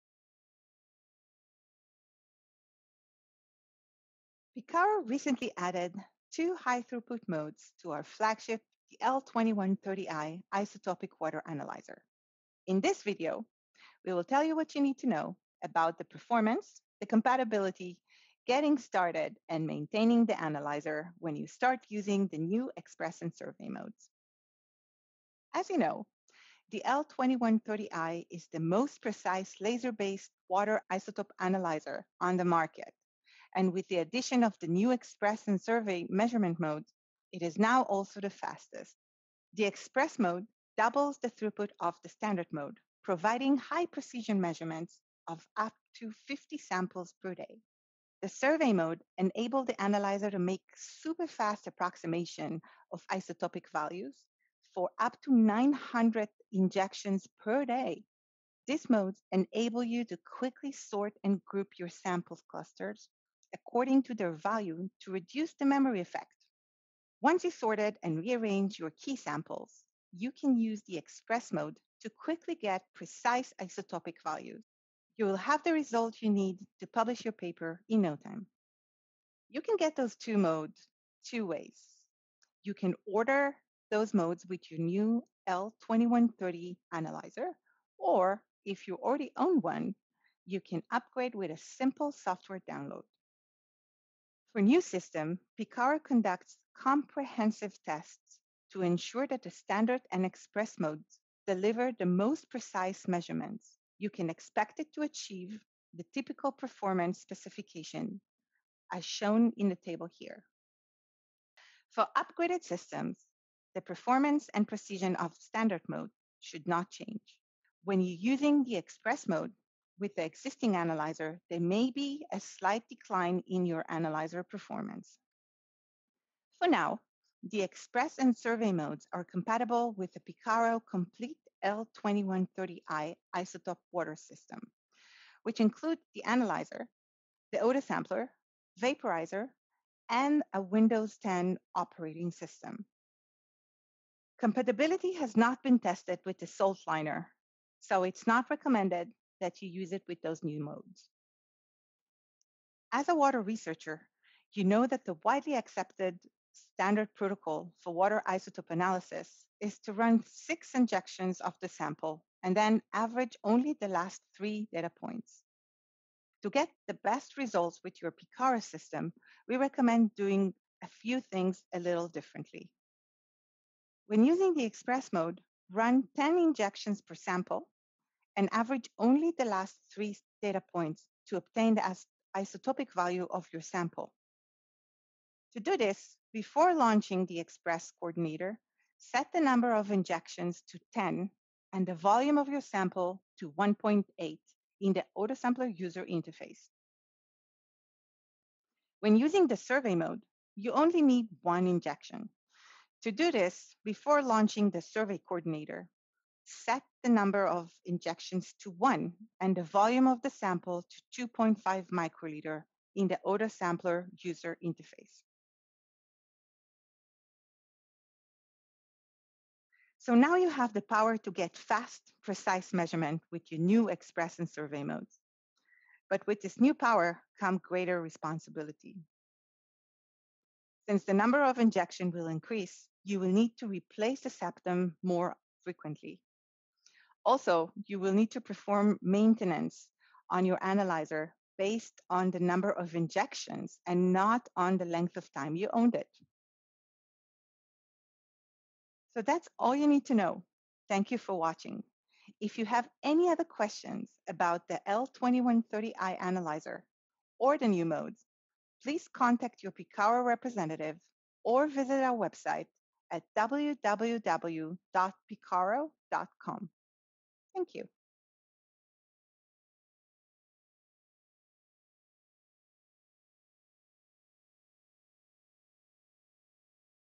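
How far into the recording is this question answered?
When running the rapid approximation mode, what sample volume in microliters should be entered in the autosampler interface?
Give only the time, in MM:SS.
03:31.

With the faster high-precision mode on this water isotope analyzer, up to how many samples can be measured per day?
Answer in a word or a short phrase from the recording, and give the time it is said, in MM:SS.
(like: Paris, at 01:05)
50, at 00:46.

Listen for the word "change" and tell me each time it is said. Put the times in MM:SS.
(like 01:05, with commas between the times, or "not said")
01:56.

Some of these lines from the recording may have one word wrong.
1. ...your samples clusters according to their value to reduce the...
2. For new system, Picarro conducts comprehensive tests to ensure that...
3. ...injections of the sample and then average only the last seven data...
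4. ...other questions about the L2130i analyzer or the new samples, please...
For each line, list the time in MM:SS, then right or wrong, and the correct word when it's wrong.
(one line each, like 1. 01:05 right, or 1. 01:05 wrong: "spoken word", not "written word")
1. 01:01 right
2. 01:34 right
3. 02:40 wrong: "three", not "seven"
4. 04:13 wrong: "modes", not "samples".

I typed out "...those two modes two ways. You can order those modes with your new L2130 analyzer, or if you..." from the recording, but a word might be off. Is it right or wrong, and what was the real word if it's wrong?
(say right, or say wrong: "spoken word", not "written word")
right.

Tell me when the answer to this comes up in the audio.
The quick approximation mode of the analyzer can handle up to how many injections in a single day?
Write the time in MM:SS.
00:55.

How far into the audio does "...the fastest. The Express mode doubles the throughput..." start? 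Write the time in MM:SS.
00:38.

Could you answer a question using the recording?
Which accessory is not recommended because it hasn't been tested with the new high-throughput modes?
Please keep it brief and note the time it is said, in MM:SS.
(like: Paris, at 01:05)
SaltLiner, at 02:26.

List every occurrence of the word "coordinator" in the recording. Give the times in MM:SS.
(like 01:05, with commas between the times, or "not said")
03:07, 03:25.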